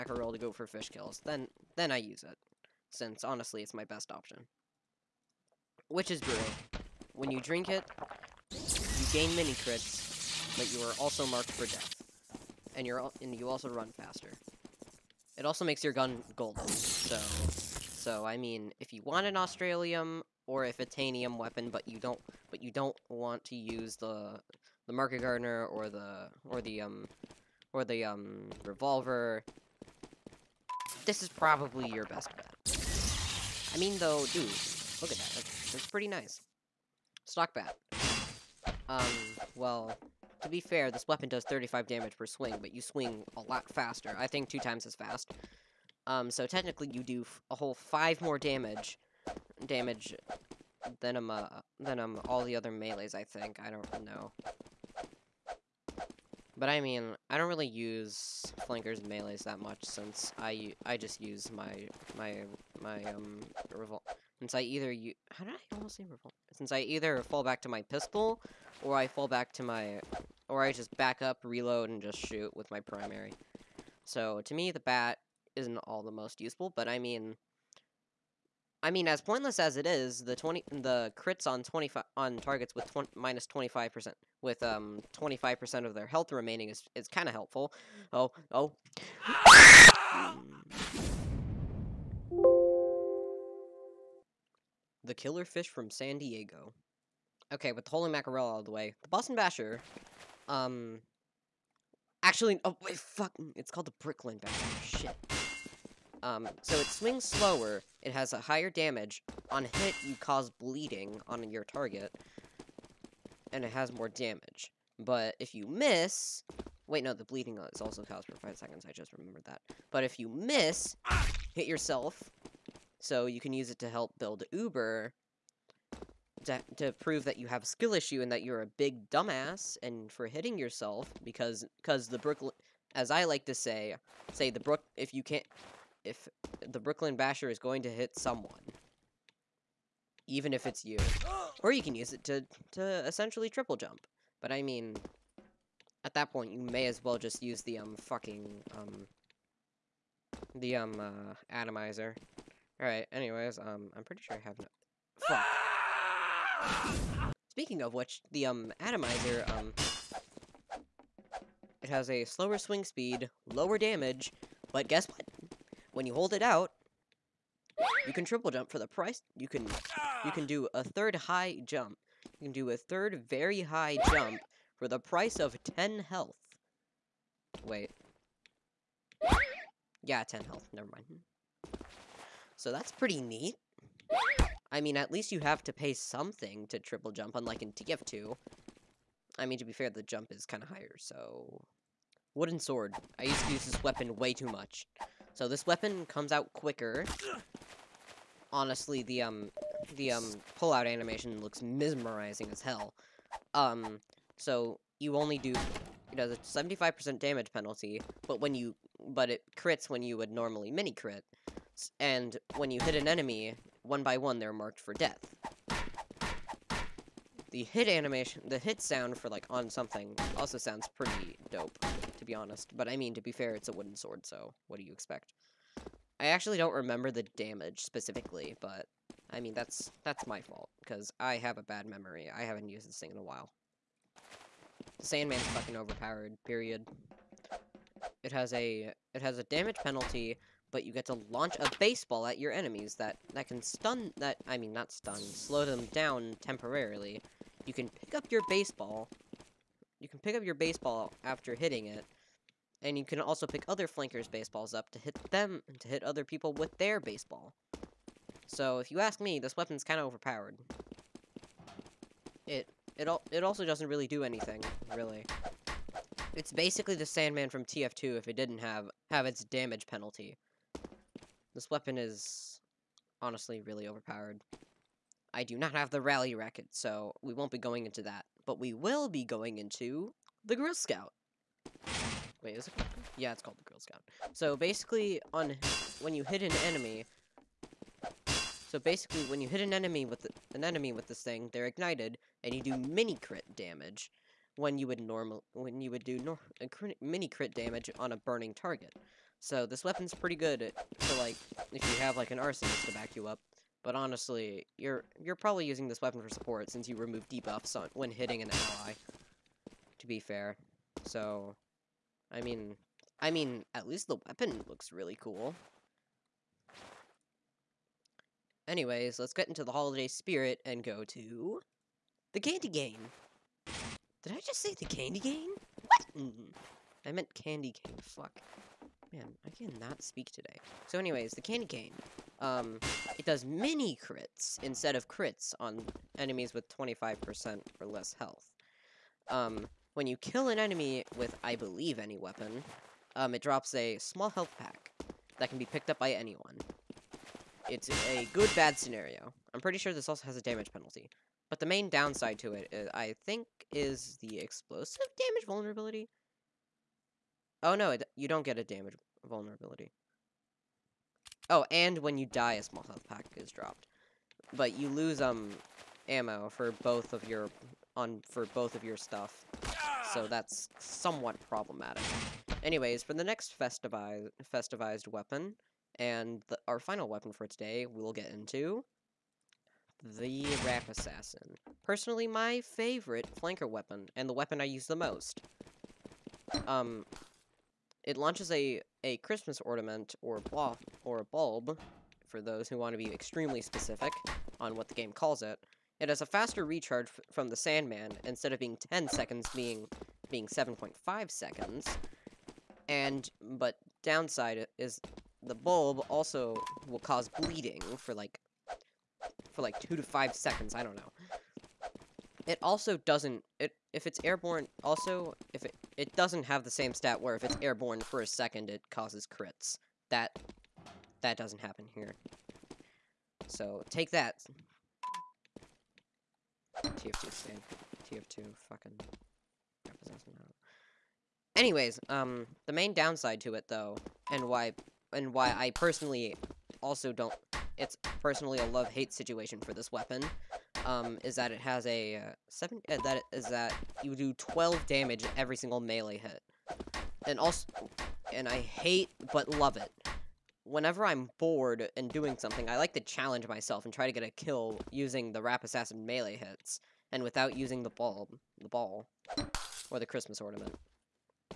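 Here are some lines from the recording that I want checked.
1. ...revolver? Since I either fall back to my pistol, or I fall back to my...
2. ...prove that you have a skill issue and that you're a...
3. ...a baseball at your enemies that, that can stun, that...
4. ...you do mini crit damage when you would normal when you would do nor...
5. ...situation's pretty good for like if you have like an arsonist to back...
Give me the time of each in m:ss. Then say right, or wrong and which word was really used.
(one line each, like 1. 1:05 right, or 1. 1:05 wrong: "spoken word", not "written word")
1. 1:06 right
2. 2:06 right
3. 4:01 right
4. 4:52 right
5. 4:59 wrong: "weapon", not "situation".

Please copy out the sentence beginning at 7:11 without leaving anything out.
Anyways, um, the main downside to it, though, and why, and why I personally also don't...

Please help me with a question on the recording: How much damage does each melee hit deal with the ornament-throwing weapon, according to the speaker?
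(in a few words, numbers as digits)
12.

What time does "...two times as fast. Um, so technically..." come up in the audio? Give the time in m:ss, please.
0:44.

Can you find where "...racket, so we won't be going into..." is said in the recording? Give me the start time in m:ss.
4:36.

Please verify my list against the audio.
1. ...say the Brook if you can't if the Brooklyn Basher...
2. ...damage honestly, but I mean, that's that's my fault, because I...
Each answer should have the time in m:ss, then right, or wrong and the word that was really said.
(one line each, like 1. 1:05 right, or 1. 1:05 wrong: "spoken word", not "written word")
1. 2:14 right
2. 3:47 wrong: "specifically", not "honestly".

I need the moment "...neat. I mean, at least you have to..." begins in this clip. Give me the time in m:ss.
3:03.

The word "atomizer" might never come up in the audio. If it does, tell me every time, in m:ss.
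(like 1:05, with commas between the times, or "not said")
2:31, 2:38.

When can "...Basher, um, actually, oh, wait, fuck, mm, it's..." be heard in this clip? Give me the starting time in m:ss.
1:39.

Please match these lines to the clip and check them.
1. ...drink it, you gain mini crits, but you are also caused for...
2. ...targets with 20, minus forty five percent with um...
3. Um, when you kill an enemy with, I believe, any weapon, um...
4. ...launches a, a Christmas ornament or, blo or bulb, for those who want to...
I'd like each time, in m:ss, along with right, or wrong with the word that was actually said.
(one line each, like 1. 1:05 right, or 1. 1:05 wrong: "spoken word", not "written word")
1. 0:07 wrong: "marked", not "caused"
2. 1:22 wrong: "twenty", not "forty"
3. 5:39 right
4. 6:28 right.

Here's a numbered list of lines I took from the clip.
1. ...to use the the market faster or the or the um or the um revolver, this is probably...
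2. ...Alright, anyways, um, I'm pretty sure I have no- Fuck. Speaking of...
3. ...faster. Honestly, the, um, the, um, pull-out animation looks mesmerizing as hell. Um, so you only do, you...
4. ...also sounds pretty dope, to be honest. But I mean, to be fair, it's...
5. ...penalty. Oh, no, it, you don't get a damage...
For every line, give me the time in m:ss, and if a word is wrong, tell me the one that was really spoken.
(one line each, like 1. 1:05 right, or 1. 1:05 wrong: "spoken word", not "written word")
1. 0:23 wrong: "gardener", not "faster"
2. 2:32 right
3. 3:16 wrong: "quicker", not "faster"
4. 3:40 right
5. 5:55 wrong: "vulnerability", not "penalty".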